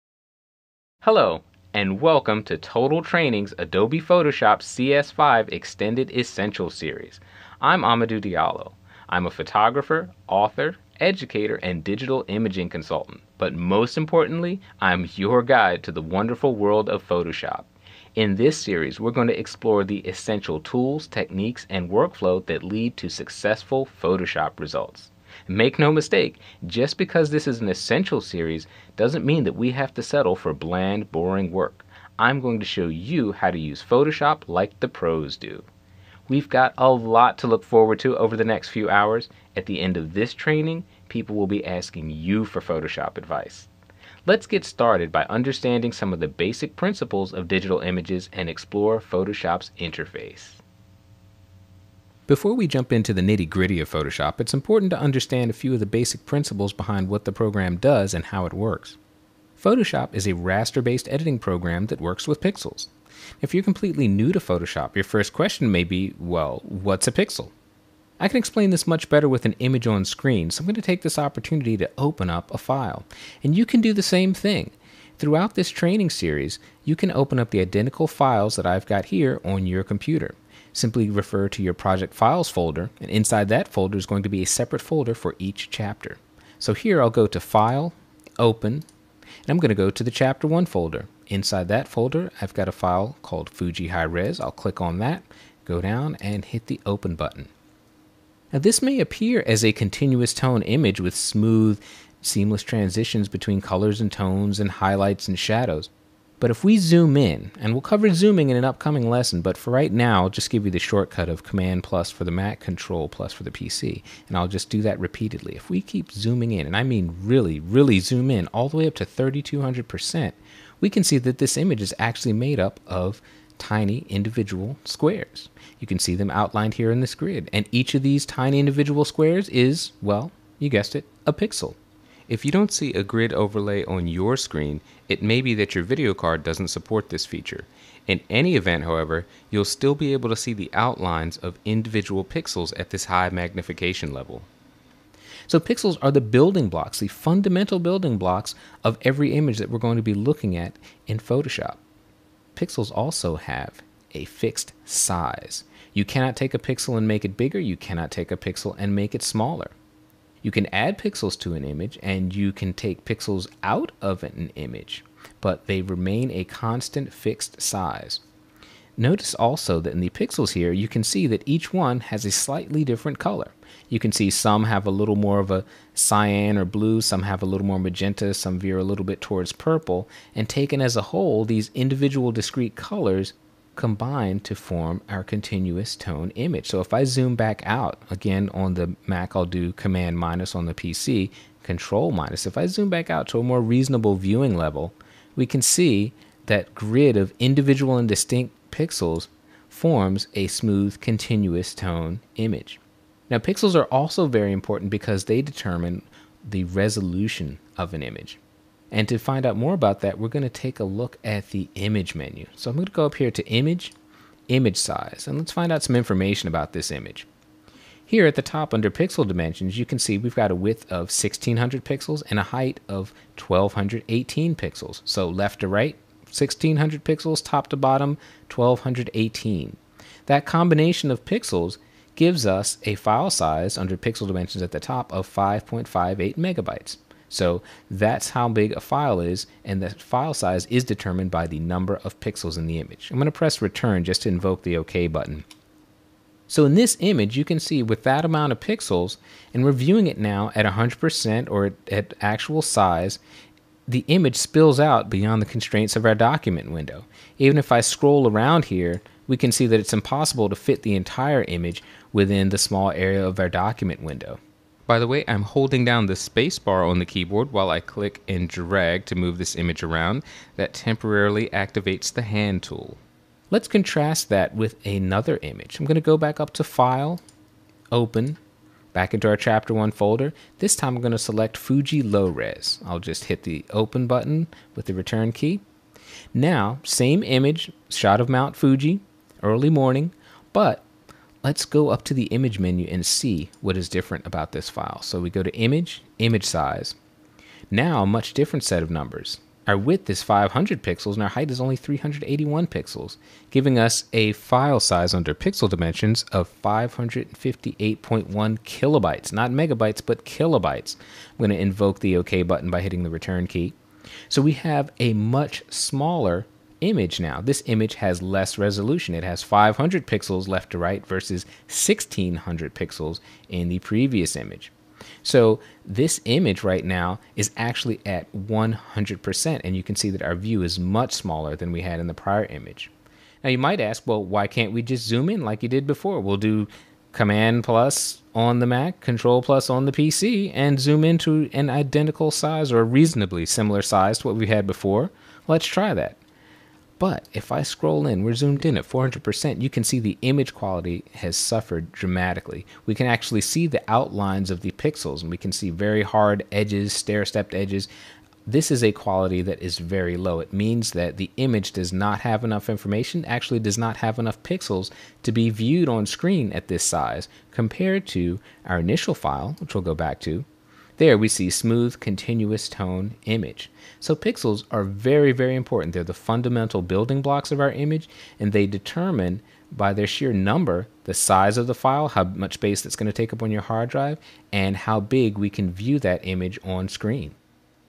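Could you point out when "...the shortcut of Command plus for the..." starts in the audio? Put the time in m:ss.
1:50.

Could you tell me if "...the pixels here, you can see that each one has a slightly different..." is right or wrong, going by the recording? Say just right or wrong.
right.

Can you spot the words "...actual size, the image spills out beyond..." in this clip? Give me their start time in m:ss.
4:12.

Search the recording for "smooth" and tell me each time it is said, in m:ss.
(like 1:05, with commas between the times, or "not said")
1:41, 3:20, 6:11.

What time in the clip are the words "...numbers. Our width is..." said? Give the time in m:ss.
4:58.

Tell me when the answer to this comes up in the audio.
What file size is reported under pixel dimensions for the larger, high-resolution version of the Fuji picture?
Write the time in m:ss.
3:55.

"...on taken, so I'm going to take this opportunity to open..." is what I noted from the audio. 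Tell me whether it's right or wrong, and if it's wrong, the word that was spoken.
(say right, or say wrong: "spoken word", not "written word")
wrong: "screen", not "taken".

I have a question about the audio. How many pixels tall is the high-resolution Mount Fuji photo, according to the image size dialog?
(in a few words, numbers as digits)
1218.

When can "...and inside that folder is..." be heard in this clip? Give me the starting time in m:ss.
1:23.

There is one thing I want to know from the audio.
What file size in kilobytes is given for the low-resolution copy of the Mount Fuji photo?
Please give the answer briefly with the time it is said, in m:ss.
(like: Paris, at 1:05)
558.1 kilobytes, at 5:06.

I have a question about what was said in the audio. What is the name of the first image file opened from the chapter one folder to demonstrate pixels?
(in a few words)
Fuji High Res.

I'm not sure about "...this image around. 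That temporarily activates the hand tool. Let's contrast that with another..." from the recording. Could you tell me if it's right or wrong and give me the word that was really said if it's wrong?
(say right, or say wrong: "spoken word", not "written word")
right.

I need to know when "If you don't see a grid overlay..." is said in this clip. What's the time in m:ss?
2:12.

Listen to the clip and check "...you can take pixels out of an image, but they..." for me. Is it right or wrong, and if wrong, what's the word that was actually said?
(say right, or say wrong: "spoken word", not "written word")
right.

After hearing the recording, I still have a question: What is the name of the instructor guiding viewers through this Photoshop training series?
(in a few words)
Amadou Diallo.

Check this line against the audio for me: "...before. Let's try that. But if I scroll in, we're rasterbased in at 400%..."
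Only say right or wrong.
wrong.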